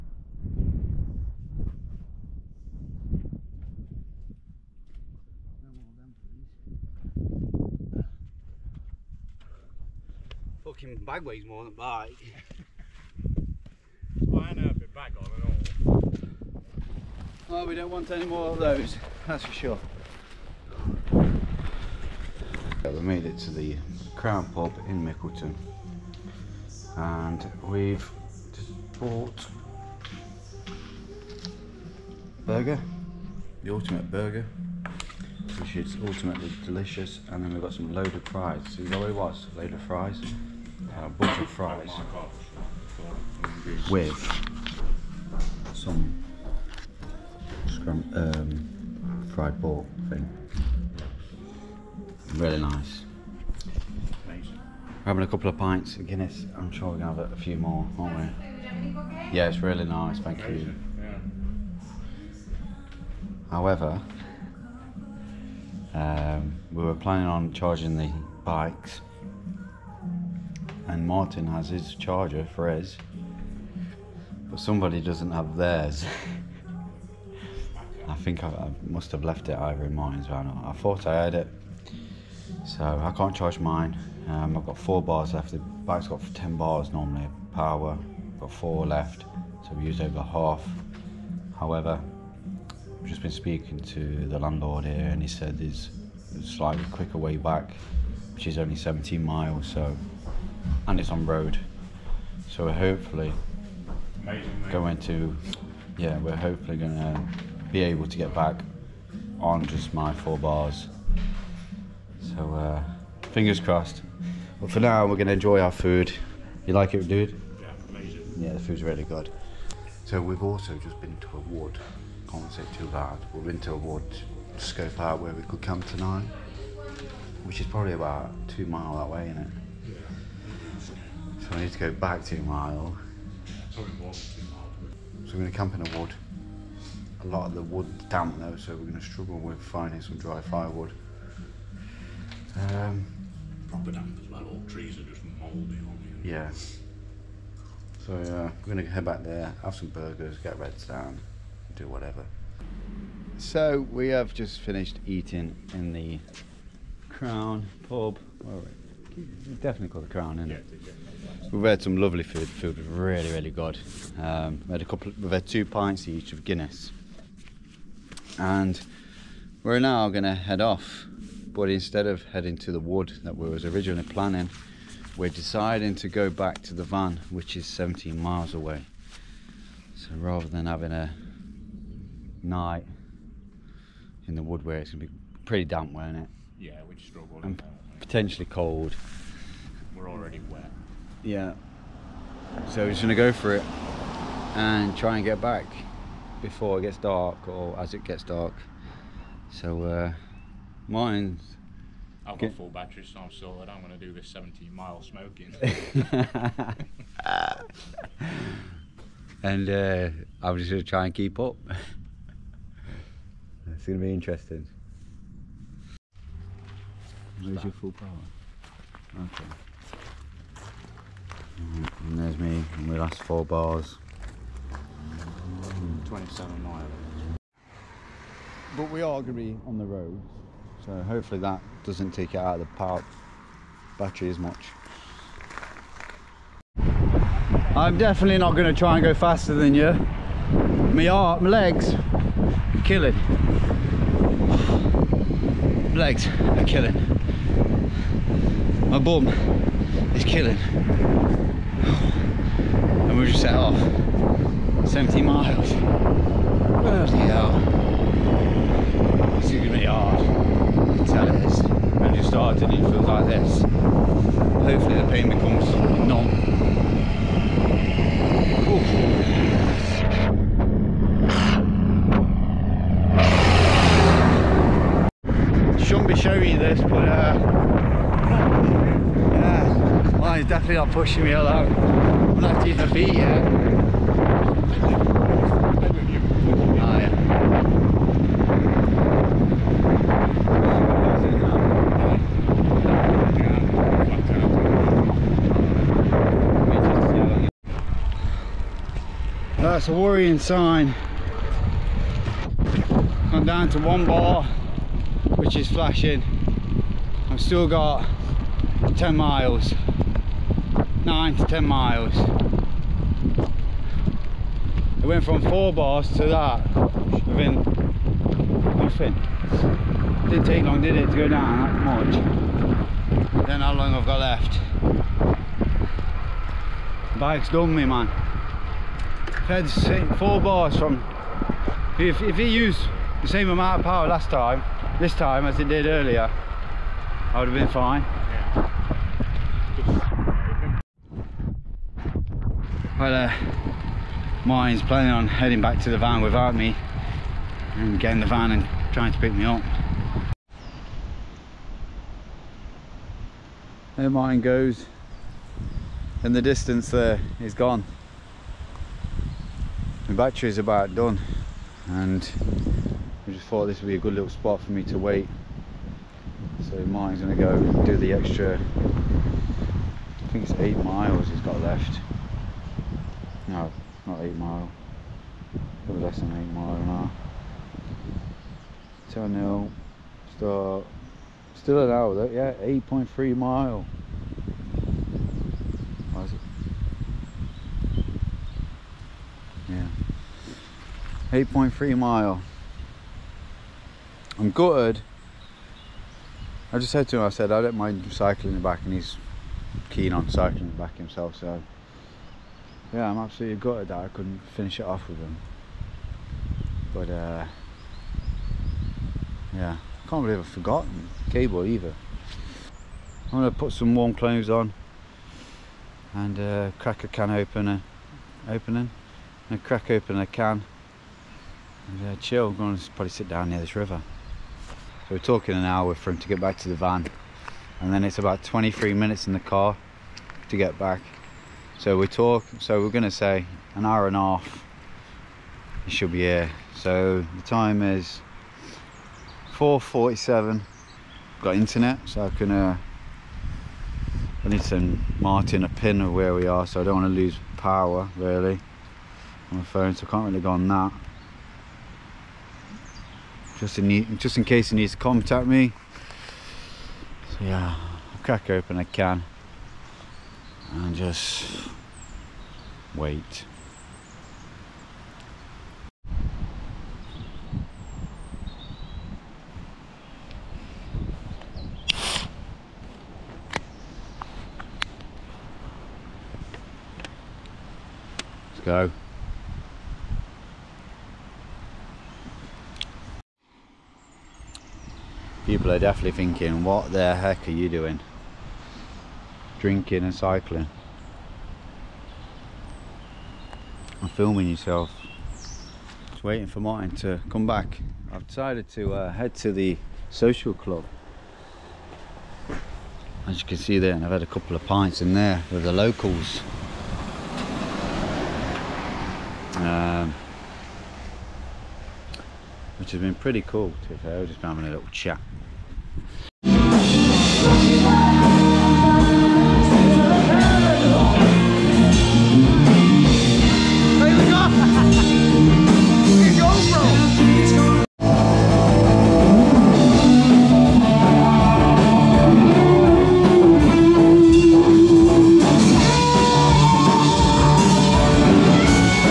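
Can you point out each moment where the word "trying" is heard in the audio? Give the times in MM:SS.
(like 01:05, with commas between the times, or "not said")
05:48.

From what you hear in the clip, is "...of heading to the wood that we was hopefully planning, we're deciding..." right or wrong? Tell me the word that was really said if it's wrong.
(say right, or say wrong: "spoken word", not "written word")
wrong: "originally", not "hopefully".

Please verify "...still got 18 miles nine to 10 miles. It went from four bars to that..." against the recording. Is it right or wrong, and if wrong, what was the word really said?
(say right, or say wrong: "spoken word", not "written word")
wrong: "10", not "18".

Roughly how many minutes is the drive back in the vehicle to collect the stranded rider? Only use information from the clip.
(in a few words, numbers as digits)
23 minutes.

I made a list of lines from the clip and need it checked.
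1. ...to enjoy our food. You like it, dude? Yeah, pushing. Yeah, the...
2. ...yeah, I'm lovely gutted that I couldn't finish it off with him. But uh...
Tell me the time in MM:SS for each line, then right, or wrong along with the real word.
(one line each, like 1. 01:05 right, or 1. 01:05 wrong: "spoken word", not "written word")
1. 01:55 wrong: "amazing", not "pushing"
2. 06:42 wrong: "absolutely", not "lovely".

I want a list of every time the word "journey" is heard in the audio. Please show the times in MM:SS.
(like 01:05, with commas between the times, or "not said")
not said.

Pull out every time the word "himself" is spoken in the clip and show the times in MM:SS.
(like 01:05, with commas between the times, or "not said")
06:40.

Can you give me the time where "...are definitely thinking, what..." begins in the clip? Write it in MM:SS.
08:05.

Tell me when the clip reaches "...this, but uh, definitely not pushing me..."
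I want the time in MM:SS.
04:36.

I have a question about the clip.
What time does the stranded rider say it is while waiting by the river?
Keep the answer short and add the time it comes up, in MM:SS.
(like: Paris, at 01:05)
4:47, at 07:19.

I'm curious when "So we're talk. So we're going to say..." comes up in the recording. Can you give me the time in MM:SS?
07:11.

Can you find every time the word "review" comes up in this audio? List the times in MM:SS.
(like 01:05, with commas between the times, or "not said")
not said.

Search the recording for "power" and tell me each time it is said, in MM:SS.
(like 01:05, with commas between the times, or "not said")
01:27, 03:37, 03:52, 05:33, 07:27.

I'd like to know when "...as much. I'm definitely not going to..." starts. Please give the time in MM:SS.
03:54.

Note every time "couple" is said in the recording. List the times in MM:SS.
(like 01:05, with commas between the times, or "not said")
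00:55, 02:44, 08:24.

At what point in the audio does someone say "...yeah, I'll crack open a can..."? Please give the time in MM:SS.
07:37.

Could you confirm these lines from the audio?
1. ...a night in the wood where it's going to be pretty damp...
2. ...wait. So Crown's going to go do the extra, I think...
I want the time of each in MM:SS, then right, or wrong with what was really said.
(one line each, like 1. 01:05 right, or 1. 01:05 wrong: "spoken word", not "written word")
1. 03:00 right
2. 06:04 wrong: "Martin", not "Crown".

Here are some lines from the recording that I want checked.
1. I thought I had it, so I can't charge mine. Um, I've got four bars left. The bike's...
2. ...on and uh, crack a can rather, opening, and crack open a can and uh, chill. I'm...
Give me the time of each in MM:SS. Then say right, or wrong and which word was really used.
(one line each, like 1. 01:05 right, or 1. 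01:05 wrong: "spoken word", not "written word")
1. 01:20 right
2. 06:54 wrong: "opener", not "rather".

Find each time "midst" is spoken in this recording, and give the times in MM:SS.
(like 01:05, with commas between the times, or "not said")
not said.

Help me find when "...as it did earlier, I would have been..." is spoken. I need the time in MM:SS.
05:35.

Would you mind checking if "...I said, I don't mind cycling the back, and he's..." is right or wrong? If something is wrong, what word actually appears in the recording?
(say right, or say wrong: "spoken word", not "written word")
right.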